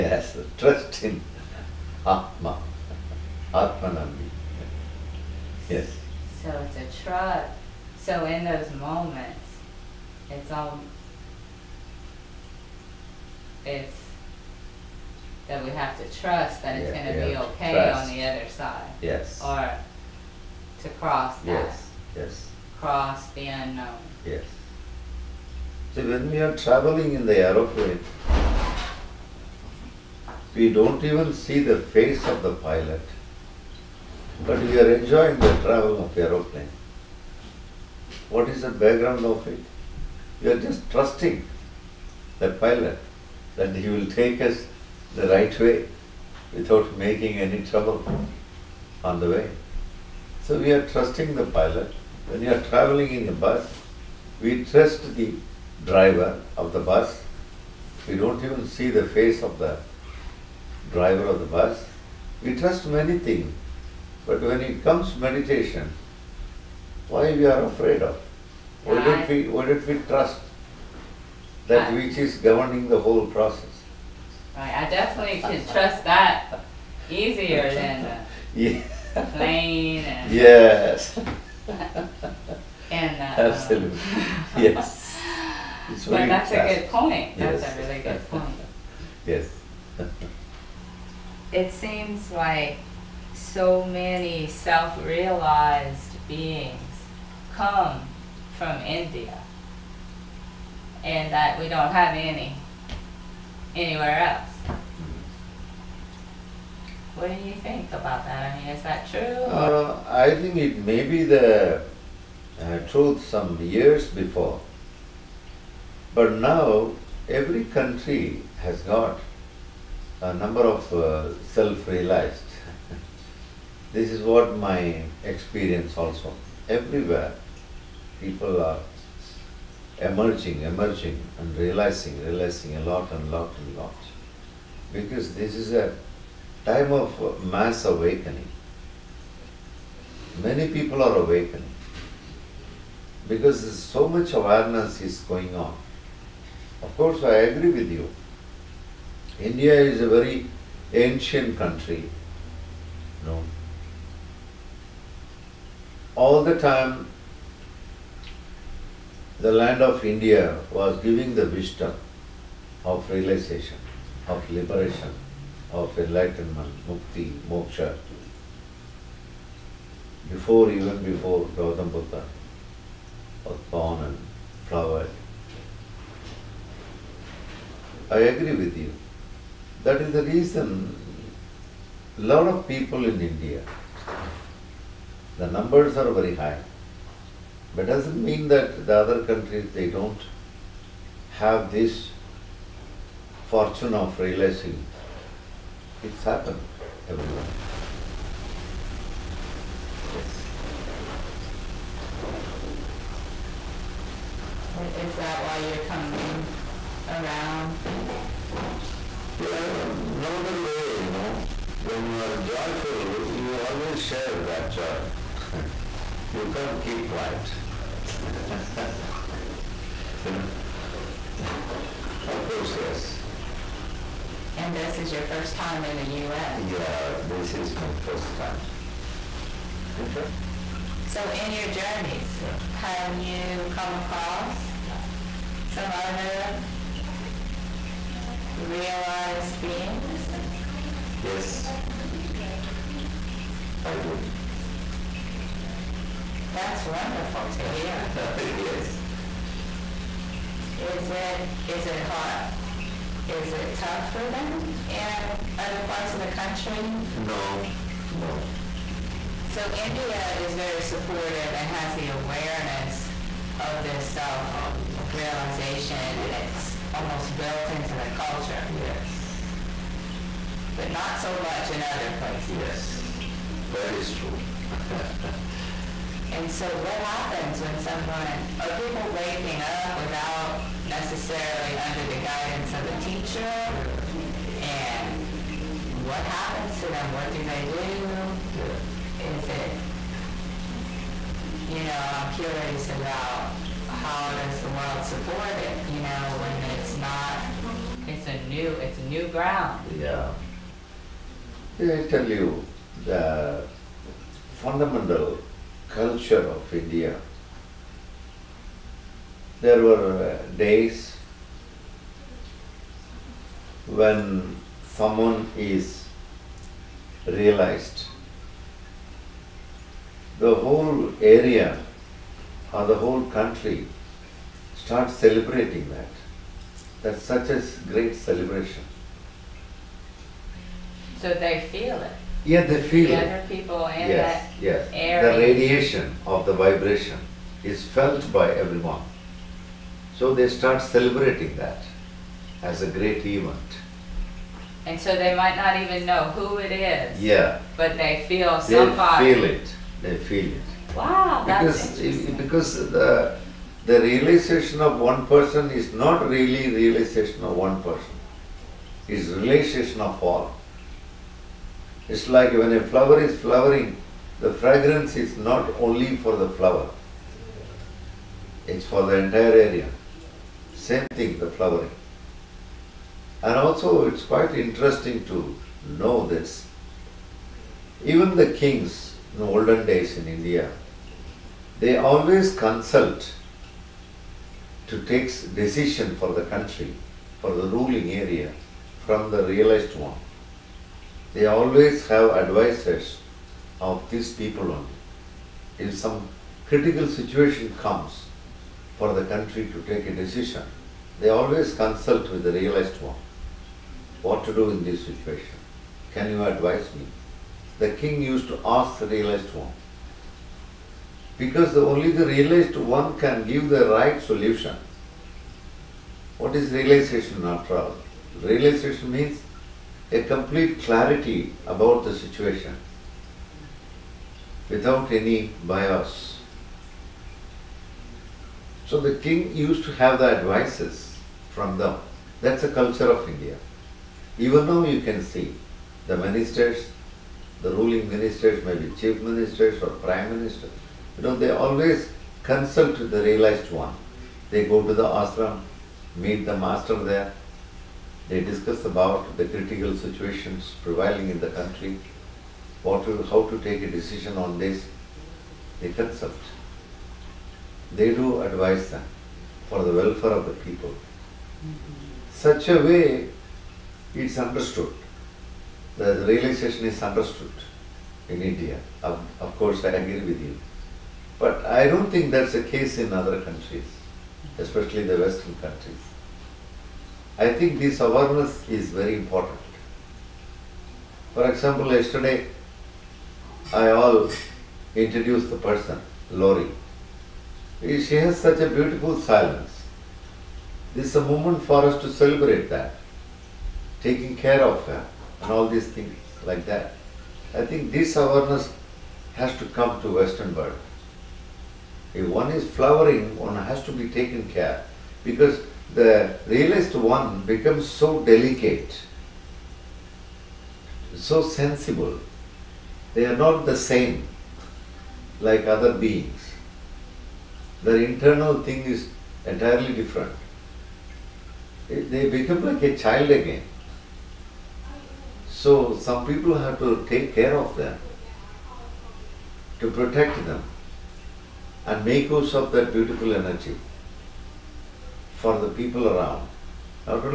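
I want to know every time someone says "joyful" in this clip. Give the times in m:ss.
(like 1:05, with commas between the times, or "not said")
3:32.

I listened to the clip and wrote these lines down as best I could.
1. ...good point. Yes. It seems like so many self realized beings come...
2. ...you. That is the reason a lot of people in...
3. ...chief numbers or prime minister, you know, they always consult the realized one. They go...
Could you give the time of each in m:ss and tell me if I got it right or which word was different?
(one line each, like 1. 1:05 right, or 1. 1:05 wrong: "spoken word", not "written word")
1. 1:28 right
2. 2:58 right
3. 7:18 wrong: "ministers", not "numbers".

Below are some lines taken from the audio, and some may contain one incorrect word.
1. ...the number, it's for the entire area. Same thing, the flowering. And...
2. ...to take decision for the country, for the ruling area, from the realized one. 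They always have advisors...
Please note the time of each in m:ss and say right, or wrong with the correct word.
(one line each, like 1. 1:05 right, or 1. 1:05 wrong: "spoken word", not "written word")
1. 6:06 wrong: "flower", not "number"
2. 6:24 right.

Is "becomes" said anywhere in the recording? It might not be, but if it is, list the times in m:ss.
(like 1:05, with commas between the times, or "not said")
8:27, 8:42.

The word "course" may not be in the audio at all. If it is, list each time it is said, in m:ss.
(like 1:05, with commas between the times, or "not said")
2:26, 3:42, 7:49.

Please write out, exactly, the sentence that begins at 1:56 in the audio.
But now every country has got a number of uh, self-realized.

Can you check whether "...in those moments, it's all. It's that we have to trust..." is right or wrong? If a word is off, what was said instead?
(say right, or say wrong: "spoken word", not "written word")
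right.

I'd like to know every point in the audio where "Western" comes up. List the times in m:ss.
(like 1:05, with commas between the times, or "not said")
7:55, 8:20.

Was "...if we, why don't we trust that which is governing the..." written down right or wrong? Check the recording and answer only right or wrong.
right.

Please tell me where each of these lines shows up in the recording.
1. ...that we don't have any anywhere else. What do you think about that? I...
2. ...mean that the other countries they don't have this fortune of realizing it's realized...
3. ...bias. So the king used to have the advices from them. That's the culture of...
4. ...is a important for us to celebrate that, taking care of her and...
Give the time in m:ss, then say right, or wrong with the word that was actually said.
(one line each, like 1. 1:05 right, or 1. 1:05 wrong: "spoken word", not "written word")
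1. 1:41 right
2. 3:08 wrong: "happened", not "realized"
3. 7:05 right
4. 8:11 wrong: "moment", not "important".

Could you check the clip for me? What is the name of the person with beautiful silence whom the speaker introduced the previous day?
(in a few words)
Lori.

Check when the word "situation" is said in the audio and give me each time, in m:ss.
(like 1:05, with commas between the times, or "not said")
6:37, 6:45, 7:02, 7:29.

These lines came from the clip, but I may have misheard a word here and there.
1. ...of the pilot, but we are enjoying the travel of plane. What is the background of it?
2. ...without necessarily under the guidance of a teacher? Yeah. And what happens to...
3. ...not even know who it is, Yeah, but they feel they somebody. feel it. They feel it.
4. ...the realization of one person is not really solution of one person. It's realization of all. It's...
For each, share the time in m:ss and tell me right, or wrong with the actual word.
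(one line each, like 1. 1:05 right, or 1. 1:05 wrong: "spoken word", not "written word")
1. 0:32 wrong: "aeroplane", not "plane"
2. 4:39 right
3. 5:45 right
4. 5:53 wrong: "realization", not "solution".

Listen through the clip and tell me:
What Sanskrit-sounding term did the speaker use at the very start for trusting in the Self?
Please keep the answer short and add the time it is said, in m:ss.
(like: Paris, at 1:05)
Atmanambi, at 0:03.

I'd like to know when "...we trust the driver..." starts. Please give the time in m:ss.
0:54.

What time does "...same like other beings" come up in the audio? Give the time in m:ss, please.
8:33.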